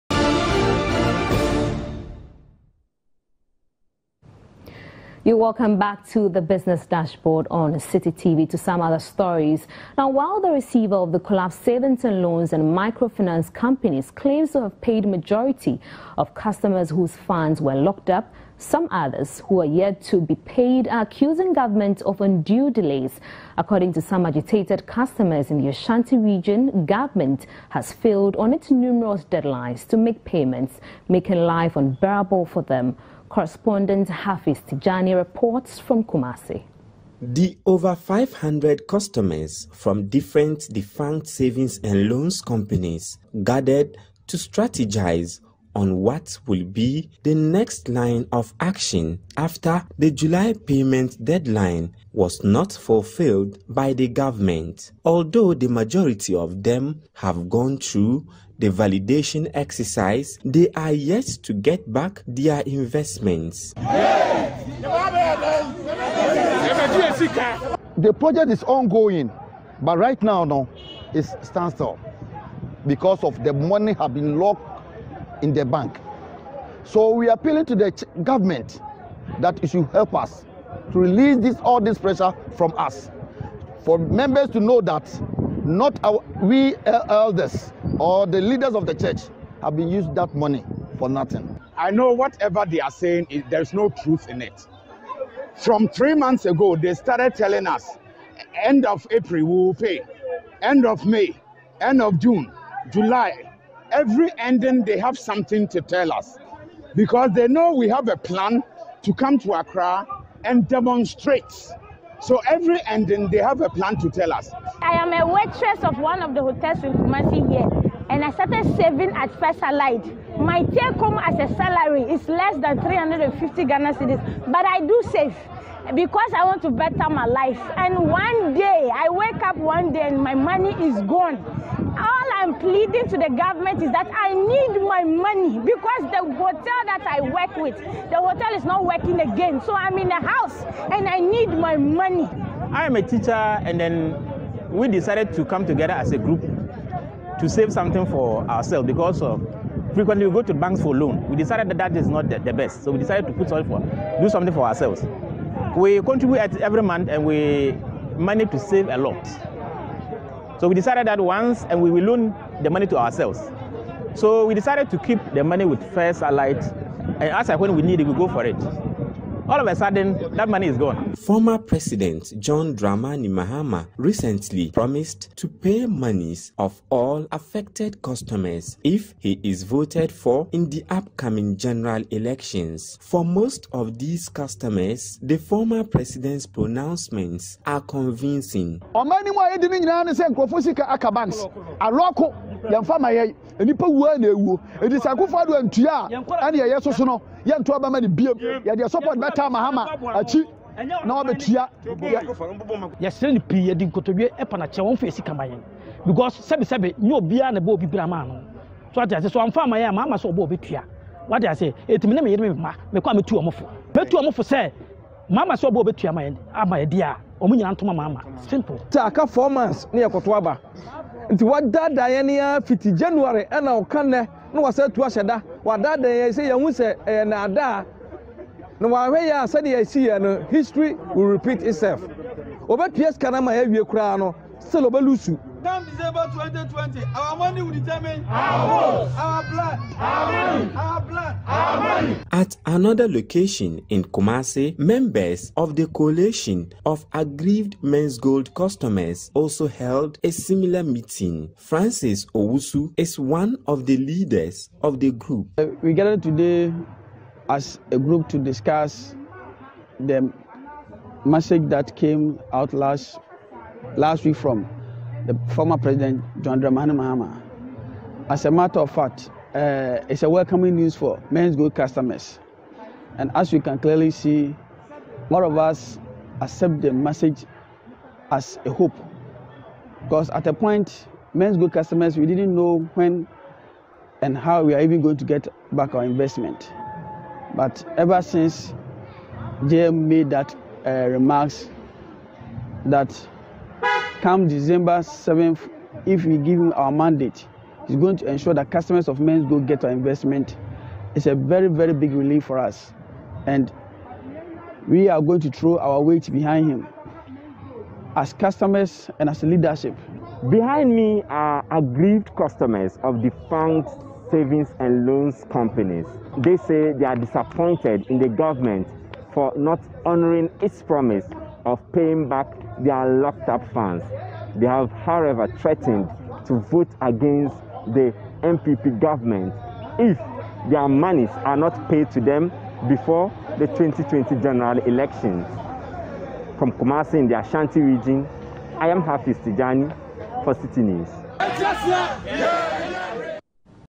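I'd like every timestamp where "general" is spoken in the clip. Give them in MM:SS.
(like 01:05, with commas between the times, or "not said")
03:01, 05:34.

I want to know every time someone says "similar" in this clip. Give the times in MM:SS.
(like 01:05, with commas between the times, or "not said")
04:10.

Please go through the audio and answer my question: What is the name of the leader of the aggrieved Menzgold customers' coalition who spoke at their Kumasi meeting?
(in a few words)
Francis Owusu.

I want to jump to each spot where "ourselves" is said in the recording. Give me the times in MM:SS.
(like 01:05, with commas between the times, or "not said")
02:28, 02:34, 02:42.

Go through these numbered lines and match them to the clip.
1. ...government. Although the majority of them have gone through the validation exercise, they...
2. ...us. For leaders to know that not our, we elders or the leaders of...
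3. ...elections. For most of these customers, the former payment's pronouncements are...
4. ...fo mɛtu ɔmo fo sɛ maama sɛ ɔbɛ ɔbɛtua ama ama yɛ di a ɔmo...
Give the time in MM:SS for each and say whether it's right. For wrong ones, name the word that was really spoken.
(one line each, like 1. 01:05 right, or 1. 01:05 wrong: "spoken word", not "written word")
1. 00:54 right
2. 01:22 wrong: "members", not "leaders"
3. 03:02 wrong: "president", not "payment"
4. 03:33 right.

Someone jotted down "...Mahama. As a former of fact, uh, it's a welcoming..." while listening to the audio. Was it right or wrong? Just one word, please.
wrong.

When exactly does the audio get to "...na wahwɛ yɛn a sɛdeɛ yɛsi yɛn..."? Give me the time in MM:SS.
03:48.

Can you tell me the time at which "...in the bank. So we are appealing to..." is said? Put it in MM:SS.
01:15.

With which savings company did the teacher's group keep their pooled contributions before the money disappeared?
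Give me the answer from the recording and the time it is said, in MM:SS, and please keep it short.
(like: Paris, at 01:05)
First Allied, at 02:45.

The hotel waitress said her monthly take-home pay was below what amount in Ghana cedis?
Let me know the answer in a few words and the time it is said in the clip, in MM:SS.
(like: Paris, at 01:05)
350, at 02:02.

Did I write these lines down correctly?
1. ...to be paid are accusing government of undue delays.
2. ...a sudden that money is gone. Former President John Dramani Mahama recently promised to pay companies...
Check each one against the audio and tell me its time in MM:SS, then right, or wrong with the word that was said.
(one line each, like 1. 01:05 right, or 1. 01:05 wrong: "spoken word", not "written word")
1. 00:20 right
2. 02:49 wrong: "monies", not "companies".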